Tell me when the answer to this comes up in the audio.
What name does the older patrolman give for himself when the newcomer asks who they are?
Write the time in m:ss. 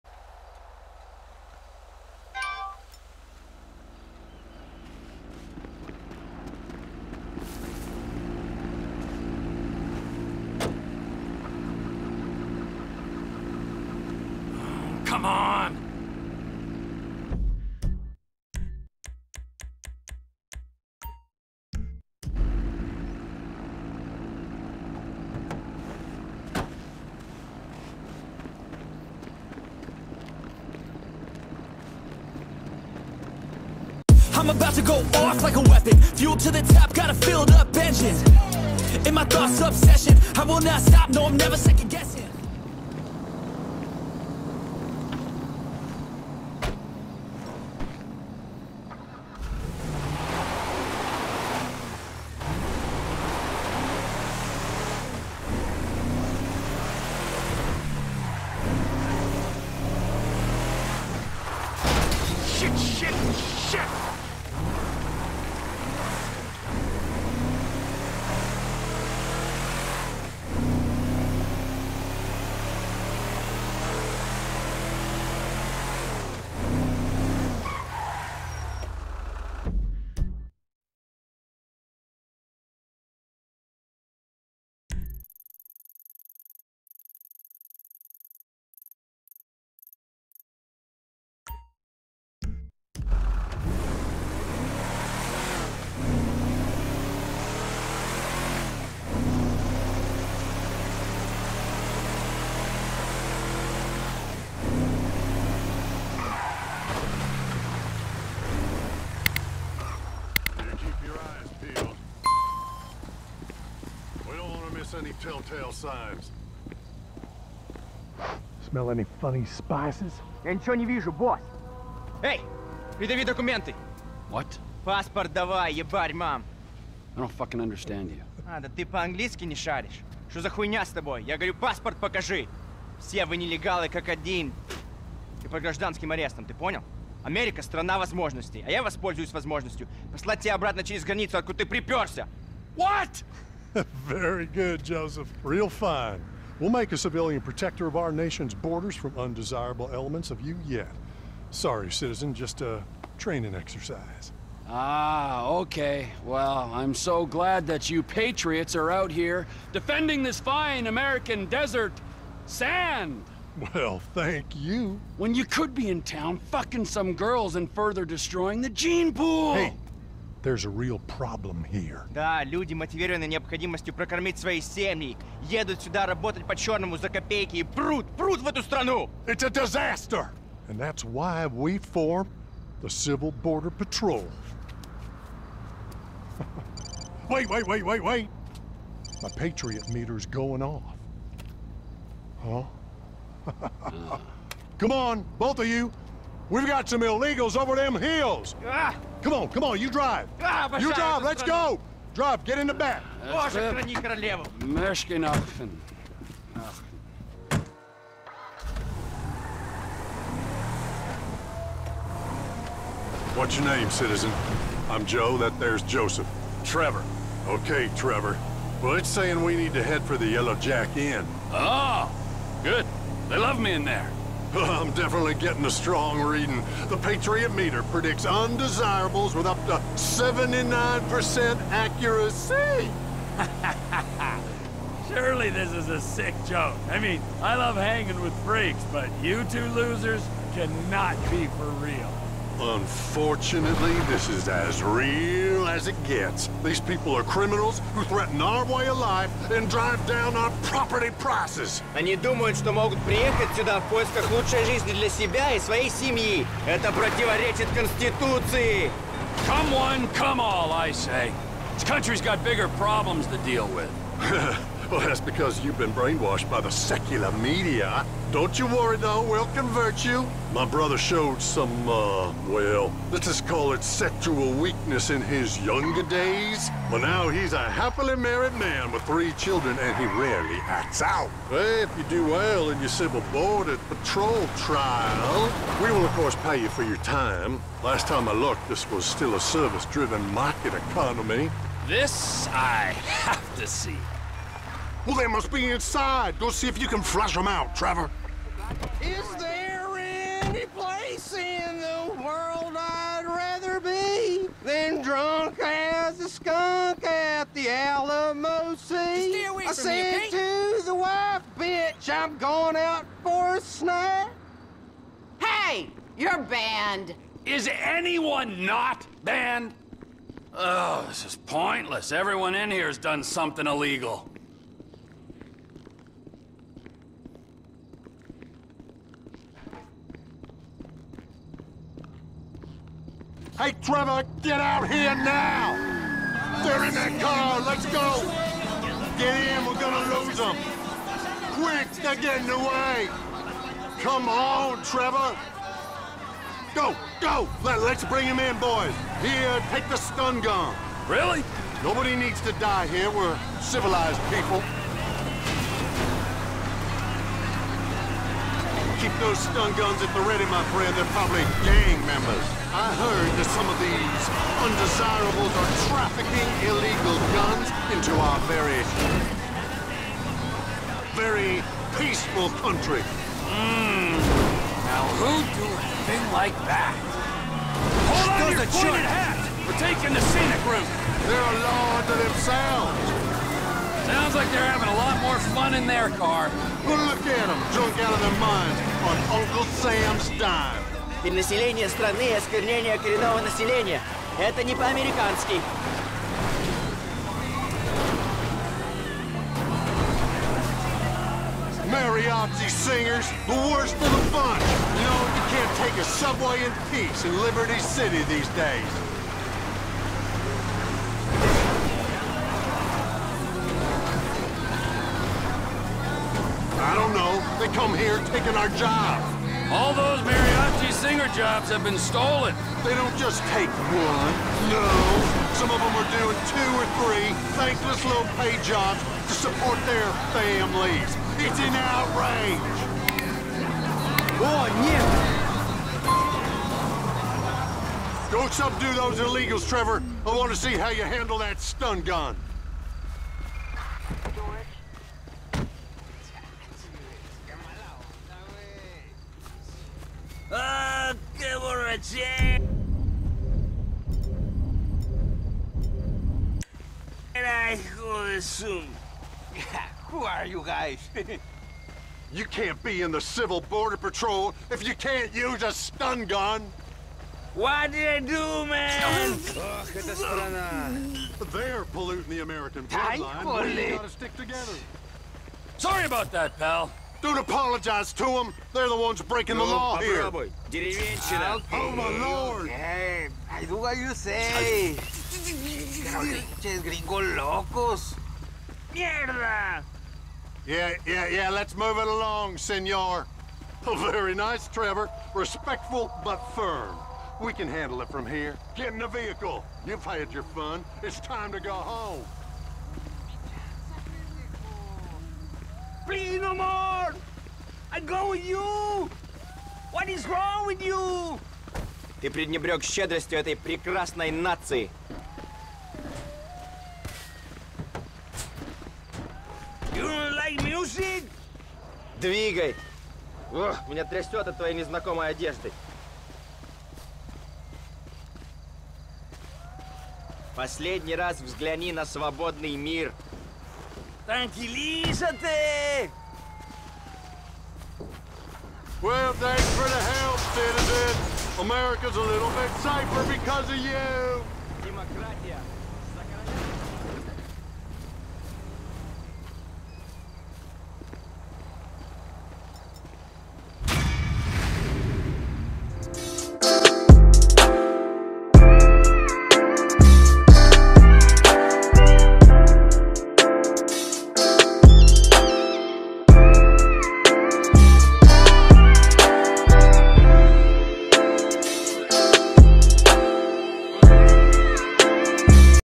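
3:34.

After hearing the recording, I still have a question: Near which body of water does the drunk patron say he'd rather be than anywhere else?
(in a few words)
Alamo Sea.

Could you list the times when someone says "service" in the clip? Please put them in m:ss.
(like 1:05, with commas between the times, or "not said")
4:49.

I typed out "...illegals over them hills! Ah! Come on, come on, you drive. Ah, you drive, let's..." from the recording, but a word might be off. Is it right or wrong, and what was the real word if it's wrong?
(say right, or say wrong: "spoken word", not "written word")
right.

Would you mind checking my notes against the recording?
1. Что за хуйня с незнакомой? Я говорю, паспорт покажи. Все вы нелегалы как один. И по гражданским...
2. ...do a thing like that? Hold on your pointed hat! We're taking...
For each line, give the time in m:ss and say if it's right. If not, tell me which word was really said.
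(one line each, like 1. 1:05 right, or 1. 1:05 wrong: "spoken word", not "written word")
1. 2:10 wrong: "тобой", not "незнакомой"
2. 6:15 right.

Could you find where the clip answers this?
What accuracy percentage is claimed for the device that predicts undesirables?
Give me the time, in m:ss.
3:49.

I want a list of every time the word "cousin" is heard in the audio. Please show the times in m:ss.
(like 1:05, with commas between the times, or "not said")
not said.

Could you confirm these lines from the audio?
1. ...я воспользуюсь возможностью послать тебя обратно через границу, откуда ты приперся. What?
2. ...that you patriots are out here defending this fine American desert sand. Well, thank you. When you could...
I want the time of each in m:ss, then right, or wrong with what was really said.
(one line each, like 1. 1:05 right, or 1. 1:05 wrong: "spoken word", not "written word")
1. 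2:18 right
2. 2:37 right.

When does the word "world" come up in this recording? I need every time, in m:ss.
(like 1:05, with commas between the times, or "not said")
5:02.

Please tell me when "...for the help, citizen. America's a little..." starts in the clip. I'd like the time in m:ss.
8:59.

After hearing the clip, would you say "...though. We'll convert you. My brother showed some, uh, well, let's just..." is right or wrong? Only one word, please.
right.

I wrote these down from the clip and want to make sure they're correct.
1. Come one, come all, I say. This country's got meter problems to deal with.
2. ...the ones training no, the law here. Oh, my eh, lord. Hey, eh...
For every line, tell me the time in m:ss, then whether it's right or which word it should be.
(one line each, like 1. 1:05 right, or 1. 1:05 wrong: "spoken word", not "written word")
1. 4:19 wrong: "bigger", not "meter"
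2. 7:58 wrong: "breaking", not "training".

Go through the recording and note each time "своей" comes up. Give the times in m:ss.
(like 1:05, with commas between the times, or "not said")
4:15.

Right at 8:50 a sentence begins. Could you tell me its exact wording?
Последний раз взгляни на свободный мир.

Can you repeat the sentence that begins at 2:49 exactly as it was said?
Hey, there's a real problem here.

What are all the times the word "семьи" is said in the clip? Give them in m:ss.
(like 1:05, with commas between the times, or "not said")
2:54, 4:15.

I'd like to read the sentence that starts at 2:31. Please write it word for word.
Sorry, citizen, just a training exercise.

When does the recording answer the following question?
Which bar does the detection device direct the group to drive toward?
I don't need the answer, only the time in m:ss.
3:40.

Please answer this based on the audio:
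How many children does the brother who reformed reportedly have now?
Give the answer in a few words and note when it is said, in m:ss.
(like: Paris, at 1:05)
3, at 4:39.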